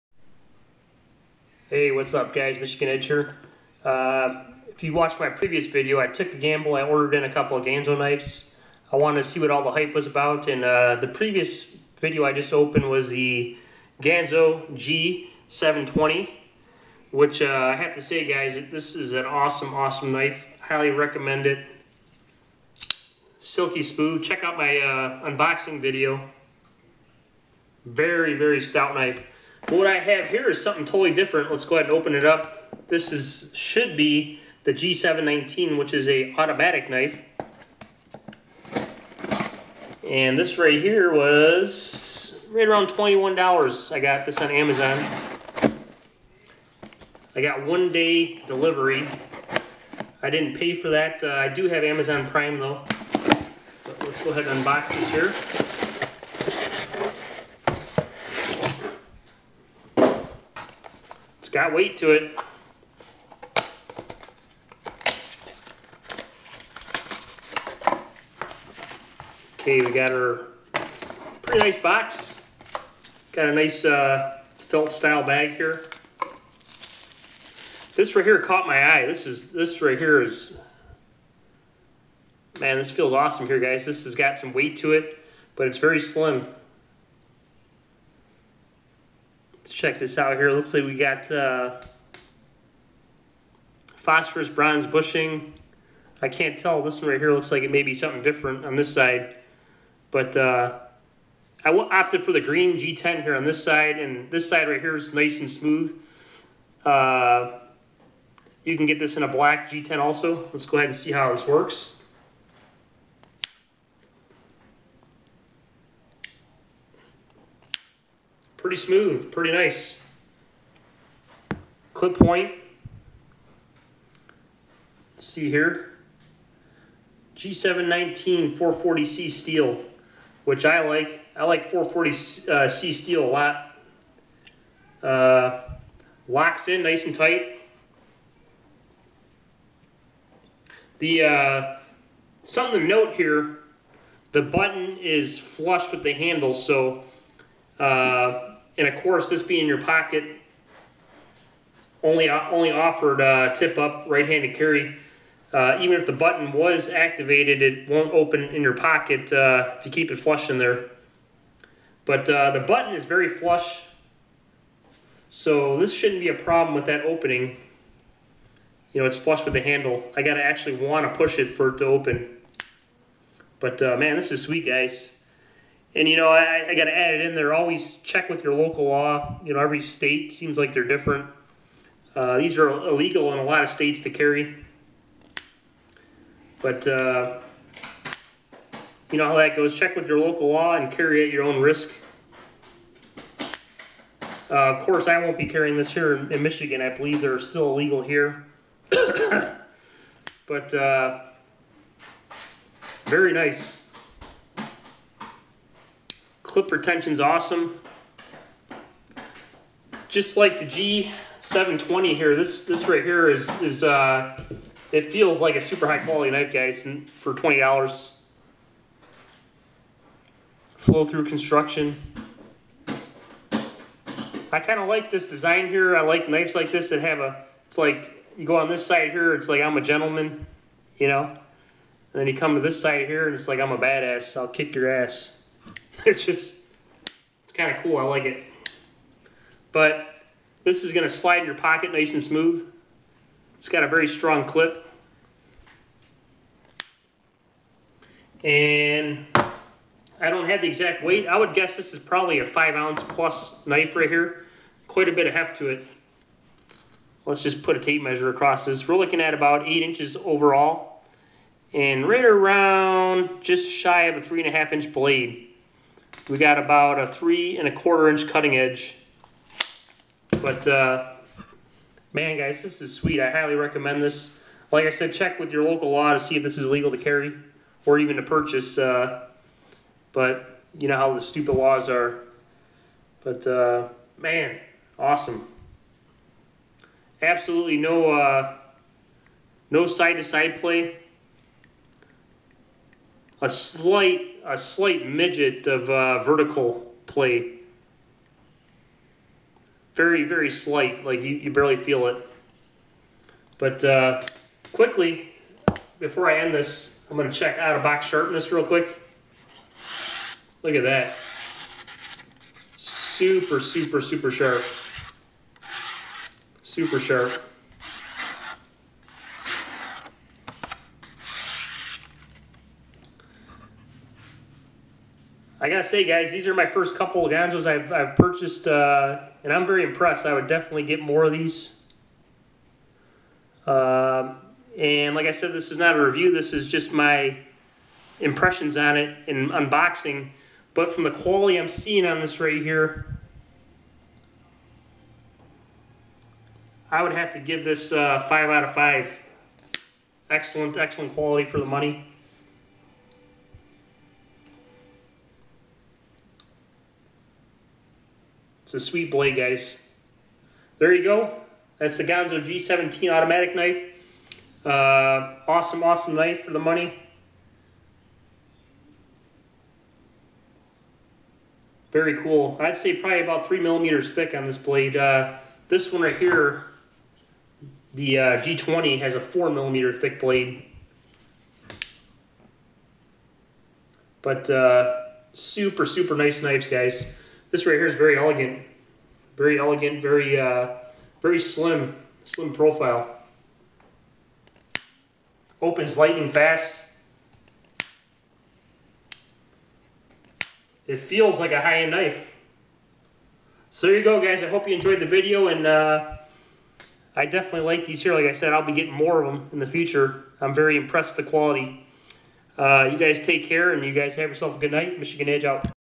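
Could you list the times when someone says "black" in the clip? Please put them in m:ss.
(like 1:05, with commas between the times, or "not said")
1:49.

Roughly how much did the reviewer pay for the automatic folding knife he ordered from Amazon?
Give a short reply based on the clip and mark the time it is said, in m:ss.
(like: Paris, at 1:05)
$21, at 0:42.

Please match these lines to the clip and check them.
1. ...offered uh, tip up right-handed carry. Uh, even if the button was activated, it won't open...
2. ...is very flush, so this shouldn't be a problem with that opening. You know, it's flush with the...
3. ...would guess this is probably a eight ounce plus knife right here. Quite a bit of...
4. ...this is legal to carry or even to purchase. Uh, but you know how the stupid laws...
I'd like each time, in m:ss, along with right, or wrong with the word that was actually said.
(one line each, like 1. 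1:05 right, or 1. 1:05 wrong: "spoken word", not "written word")
1. 2:32 right
2. 2:42 right
3. 4:11 wrong: "five", not "eight"
4. 4:36 right.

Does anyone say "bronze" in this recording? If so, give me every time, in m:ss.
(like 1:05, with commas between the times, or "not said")
1:34.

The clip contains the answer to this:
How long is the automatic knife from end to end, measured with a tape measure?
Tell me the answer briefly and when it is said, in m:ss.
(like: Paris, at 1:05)
8 inches, at 4:19.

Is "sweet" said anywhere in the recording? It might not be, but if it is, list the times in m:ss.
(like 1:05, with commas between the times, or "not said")
2:54, 4:32, 5:58.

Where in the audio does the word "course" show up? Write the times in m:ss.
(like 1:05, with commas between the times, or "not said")
2:29, 3:14.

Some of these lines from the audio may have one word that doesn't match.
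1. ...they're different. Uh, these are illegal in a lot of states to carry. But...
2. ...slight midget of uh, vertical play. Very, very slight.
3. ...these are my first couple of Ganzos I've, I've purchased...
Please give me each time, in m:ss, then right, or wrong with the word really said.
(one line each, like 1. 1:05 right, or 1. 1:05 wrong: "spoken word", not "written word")
1. 3:00 right
2. 4:54 right
3. 5:26 right.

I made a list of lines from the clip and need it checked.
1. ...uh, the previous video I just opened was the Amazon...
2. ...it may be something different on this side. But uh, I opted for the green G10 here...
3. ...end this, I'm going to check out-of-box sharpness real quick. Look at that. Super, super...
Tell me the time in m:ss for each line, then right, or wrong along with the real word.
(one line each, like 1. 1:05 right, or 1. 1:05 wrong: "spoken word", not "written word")
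1. 0:10 wrong: "Ganzo", not "Amazon"
2. 1:37 right
3. 5:06 right.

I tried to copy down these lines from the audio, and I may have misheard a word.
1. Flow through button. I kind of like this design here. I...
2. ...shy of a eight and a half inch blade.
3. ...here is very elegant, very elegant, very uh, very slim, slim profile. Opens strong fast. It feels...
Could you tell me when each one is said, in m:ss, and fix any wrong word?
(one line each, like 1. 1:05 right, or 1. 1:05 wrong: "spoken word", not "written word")
1. 3:40 wrong: "construction", not "button"
2. 4:23 wrong: "three", not "eight"
3. 6:27 wrong: "lightning", not "strong".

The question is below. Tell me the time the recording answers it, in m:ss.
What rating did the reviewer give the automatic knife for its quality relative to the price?
5:48.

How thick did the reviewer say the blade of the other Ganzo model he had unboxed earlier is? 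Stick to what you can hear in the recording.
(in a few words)
4 millimeters.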